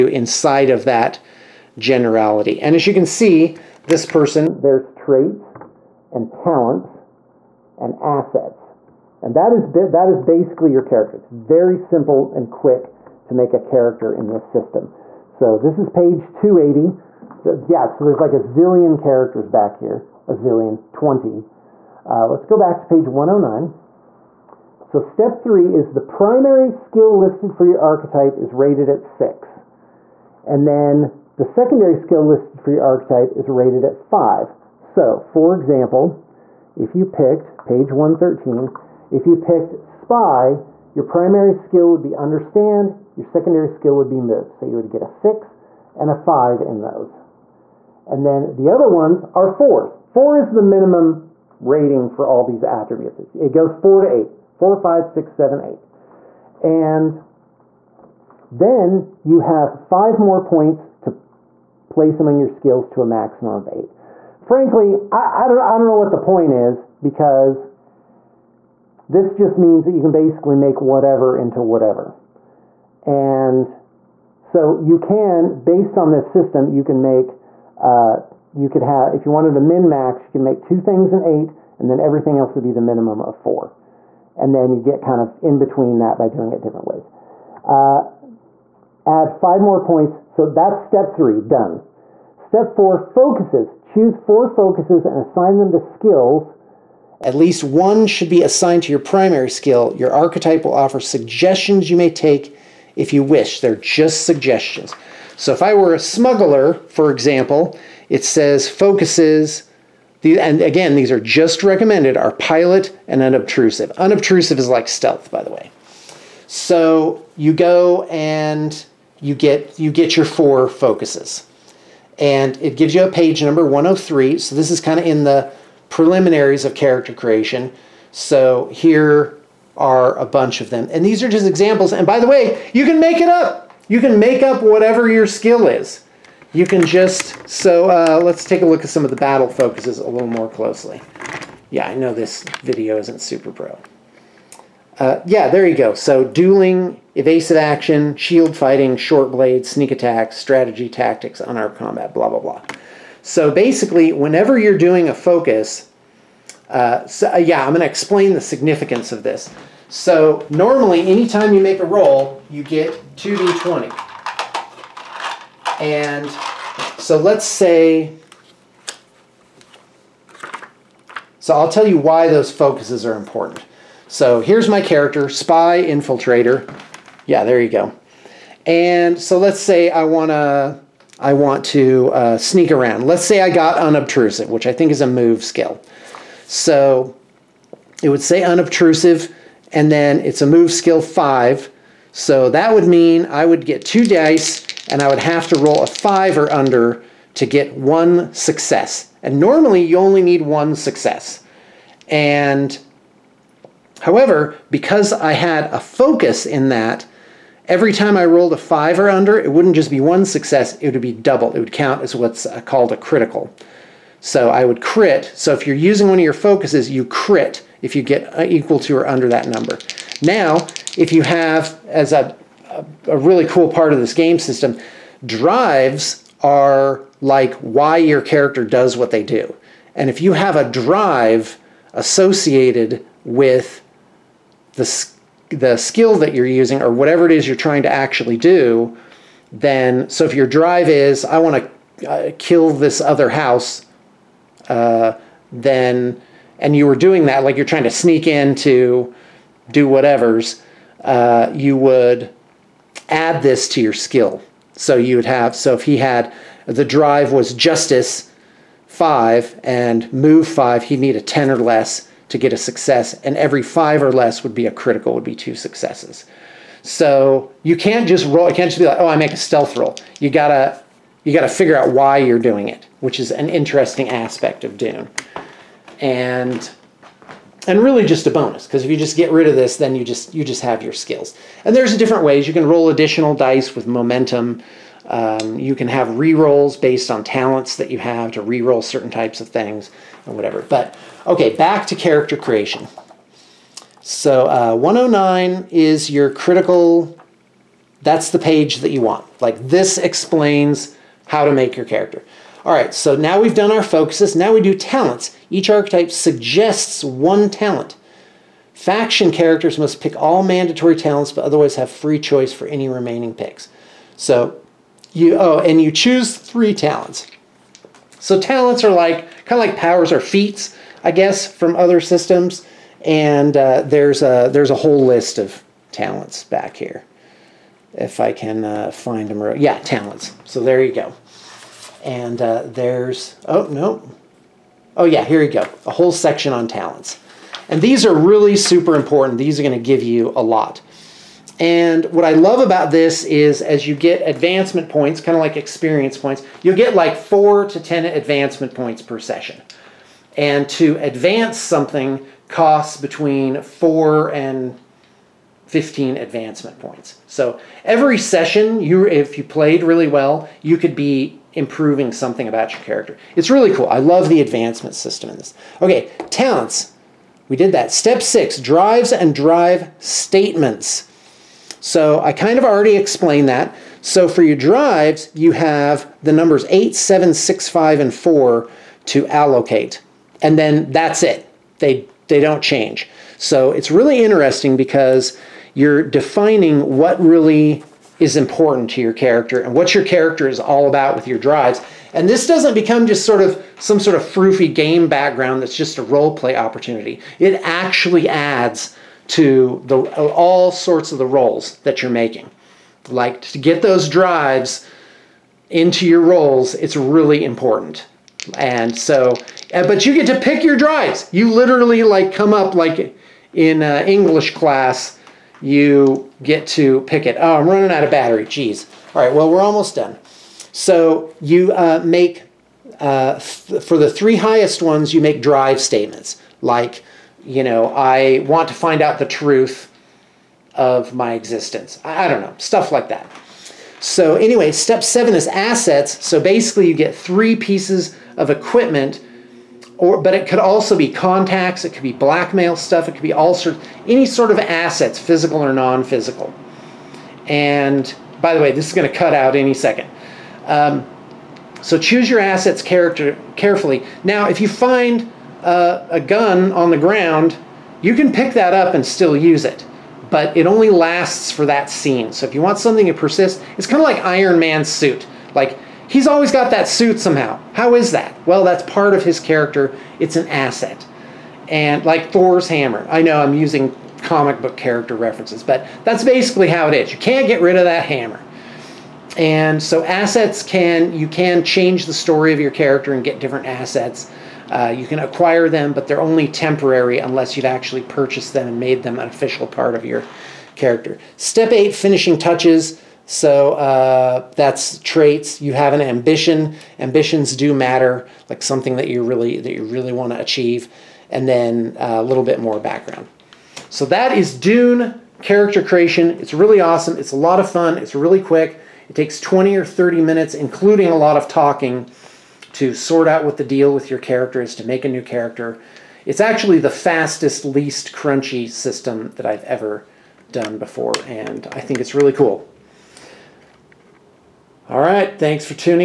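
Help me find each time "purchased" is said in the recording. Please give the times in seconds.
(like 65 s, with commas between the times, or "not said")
488 s.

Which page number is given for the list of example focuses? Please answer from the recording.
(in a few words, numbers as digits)
103.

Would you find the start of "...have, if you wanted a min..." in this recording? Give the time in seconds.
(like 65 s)
78 s.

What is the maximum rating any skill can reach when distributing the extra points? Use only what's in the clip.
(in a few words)
8.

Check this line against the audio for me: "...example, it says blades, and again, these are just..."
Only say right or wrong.
wrong.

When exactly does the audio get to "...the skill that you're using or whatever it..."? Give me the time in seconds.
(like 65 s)
235 s.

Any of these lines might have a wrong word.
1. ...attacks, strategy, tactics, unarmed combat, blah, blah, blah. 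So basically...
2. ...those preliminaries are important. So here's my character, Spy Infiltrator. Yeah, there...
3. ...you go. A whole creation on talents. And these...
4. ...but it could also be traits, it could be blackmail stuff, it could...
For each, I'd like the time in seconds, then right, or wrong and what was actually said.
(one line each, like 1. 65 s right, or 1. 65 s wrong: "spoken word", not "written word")
1. 149 s right
2. 172 s wrong: "focuses", not "preliminaries"
3. 335 s wrong: "section", not "creation"
4. 440 s wrong: "contacts", not "traits".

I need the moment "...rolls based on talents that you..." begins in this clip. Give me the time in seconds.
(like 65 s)
286 s.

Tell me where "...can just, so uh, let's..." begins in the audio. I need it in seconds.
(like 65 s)
136 s.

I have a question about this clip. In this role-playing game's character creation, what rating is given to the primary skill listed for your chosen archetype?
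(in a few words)
6.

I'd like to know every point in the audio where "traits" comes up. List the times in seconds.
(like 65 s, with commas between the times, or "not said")
4 s, 494 s.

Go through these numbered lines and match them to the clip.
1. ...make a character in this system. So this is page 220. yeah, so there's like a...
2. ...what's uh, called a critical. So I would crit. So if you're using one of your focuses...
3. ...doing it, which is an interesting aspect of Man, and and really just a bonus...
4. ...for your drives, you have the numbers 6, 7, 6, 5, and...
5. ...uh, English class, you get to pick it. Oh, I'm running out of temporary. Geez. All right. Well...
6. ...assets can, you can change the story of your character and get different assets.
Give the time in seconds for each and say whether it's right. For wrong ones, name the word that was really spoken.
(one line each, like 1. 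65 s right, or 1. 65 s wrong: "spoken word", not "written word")
1. 13 s wrong: "280", not "220"
2. 212 s right
3. 272 s wrong: "Dune", not "Man"
4. 374 s wrong: "8", not "6"
5. 413 s wrong: "battery", not "temporary"
6. 480 s right.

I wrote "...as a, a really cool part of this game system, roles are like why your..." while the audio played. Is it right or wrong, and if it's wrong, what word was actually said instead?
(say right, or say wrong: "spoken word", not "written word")
wrong: "drives", not "roles".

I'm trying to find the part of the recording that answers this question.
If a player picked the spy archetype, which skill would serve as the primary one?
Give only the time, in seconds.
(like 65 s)
42 s.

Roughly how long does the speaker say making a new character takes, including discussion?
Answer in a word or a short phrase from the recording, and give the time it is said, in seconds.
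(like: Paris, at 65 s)
20 or 30 minutes, at 509 s.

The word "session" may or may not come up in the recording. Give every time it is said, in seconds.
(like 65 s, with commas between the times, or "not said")
349 s, 358 s.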